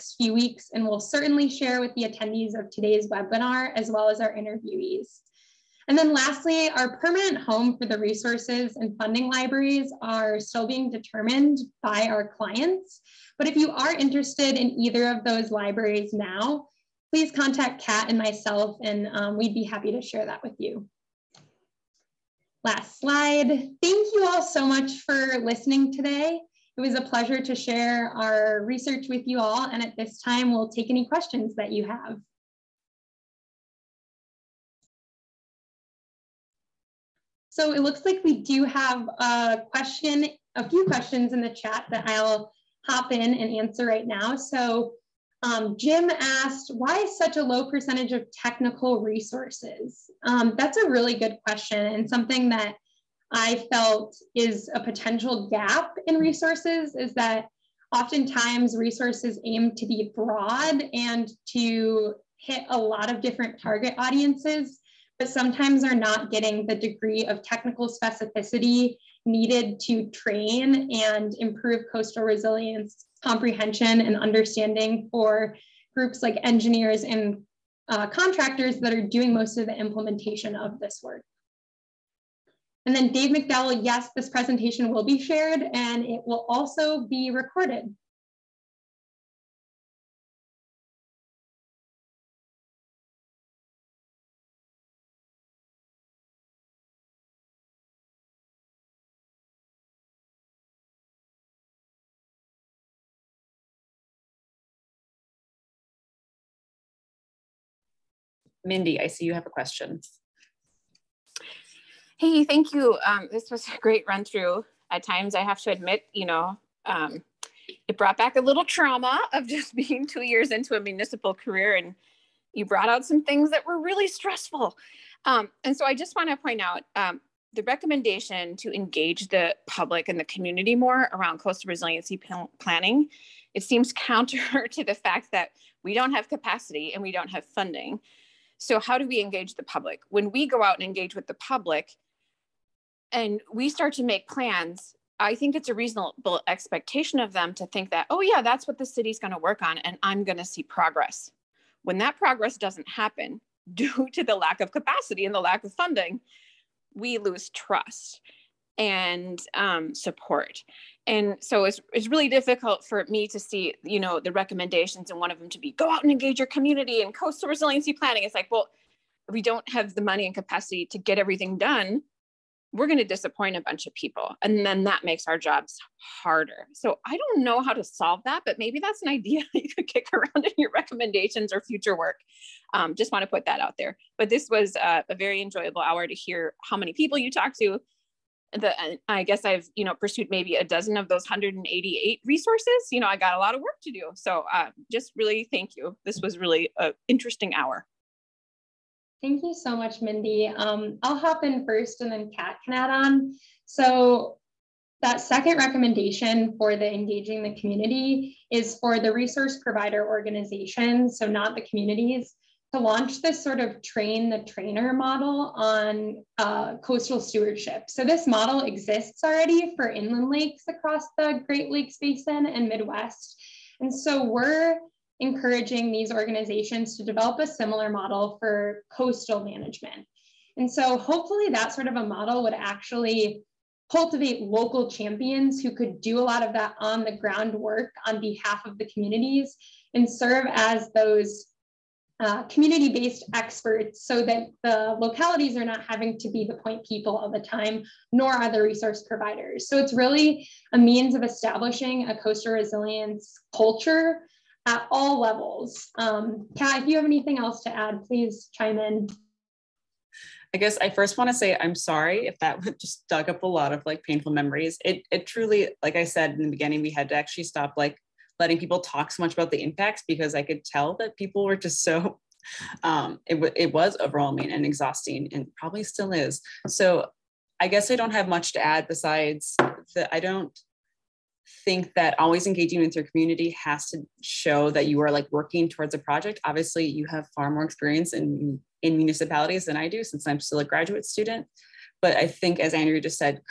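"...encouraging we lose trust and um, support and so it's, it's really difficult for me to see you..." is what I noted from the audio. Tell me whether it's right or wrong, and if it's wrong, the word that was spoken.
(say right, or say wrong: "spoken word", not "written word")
wrong: "funding", not "encouraging".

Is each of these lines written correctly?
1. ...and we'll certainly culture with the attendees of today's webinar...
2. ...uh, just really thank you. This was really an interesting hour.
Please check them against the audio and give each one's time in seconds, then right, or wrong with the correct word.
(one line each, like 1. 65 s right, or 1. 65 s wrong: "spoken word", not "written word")
1. 0 s wrong: "share", not "culture"
2. 194 s right.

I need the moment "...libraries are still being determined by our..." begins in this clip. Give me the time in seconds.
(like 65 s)
9 s.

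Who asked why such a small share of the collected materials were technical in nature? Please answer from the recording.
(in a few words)
Jim.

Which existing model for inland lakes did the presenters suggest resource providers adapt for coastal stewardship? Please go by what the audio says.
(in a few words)
Train the trainer.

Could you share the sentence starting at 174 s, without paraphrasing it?
And then that makes our jobs harder.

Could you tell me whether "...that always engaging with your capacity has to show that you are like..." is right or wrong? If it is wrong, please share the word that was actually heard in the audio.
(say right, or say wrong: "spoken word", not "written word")
wrong: "community", not "capacity".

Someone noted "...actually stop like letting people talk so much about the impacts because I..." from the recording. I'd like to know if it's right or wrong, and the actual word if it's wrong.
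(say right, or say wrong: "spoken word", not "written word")
right.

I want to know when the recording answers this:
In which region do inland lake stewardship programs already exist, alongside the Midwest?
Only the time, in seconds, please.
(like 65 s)
221 s.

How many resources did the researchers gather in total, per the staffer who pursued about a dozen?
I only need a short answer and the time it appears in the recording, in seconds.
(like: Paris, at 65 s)
188, at 191 s.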